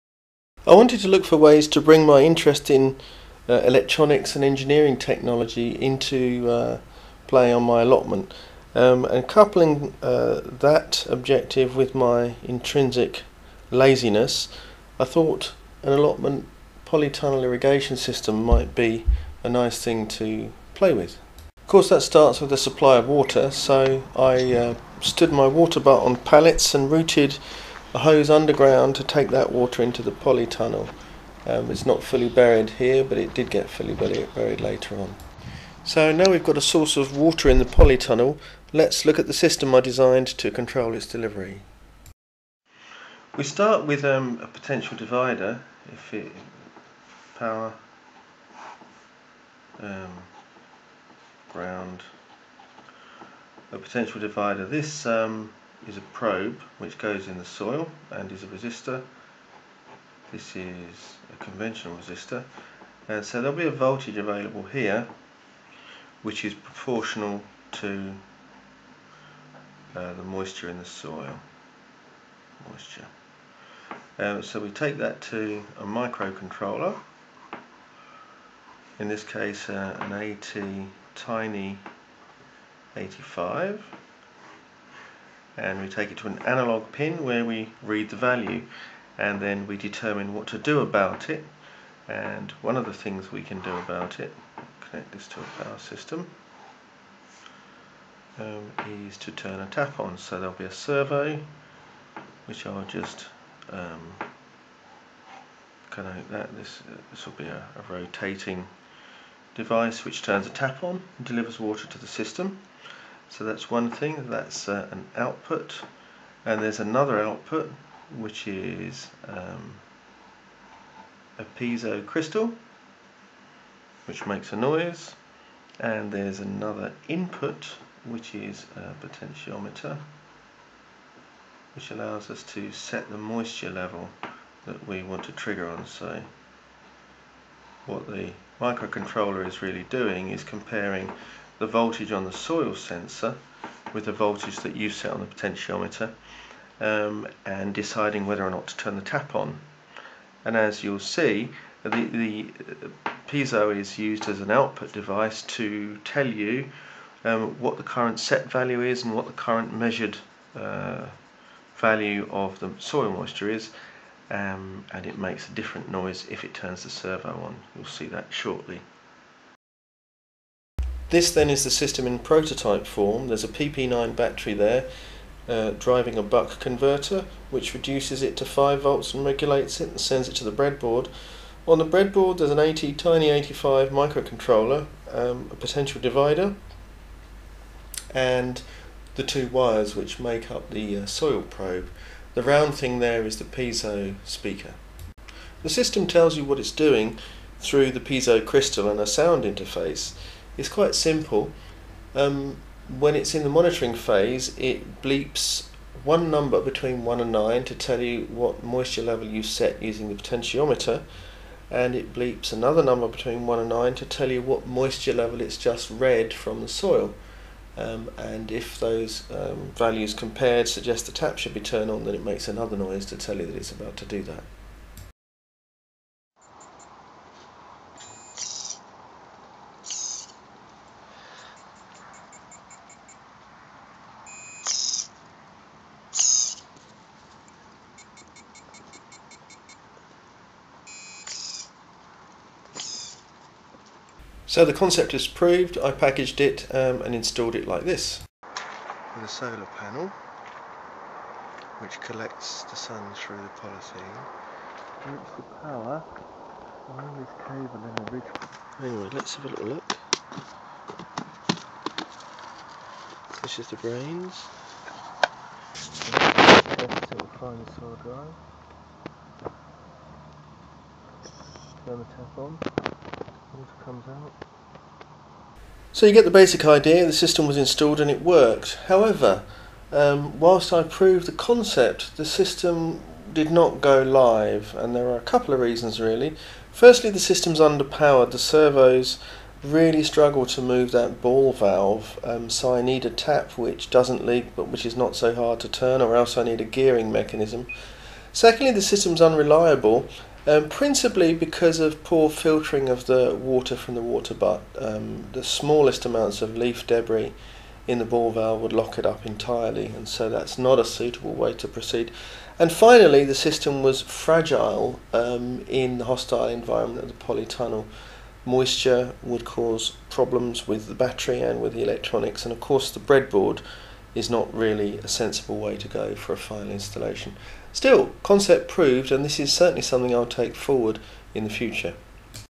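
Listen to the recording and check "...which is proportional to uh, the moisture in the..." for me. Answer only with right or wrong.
right.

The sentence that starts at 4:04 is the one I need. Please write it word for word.
So the concept is proved, I packaged it um, and installed it like this.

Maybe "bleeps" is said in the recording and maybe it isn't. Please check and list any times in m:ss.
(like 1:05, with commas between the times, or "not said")
3:25, 3:32.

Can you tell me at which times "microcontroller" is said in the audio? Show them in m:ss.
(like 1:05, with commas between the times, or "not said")
1:15, 2:18, 3:03.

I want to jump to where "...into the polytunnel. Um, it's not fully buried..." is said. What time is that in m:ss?
0:29.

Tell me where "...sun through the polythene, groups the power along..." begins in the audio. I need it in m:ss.
4:12.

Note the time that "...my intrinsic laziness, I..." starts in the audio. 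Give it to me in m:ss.
0:11.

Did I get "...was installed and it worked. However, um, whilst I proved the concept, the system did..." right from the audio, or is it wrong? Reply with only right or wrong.
right.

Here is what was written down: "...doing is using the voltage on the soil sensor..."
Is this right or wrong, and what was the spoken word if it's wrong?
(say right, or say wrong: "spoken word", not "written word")
wrong: "comparing", not "using".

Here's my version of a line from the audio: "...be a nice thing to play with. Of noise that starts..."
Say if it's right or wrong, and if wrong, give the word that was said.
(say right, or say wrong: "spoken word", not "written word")
wrong: "course", not "noise".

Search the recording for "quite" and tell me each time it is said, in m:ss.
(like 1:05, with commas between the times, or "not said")
3:20.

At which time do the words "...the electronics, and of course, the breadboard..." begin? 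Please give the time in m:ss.
5:21.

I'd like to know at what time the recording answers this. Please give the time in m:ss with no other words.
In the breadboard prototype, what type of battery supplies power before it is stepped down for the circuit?
2:53.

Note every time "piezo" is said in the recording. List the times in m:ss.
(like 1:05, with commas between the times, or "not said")
2:01, 2:33, 3:13, 3:17.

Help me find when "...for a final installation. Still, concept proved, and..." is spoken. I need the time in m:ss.
5:26.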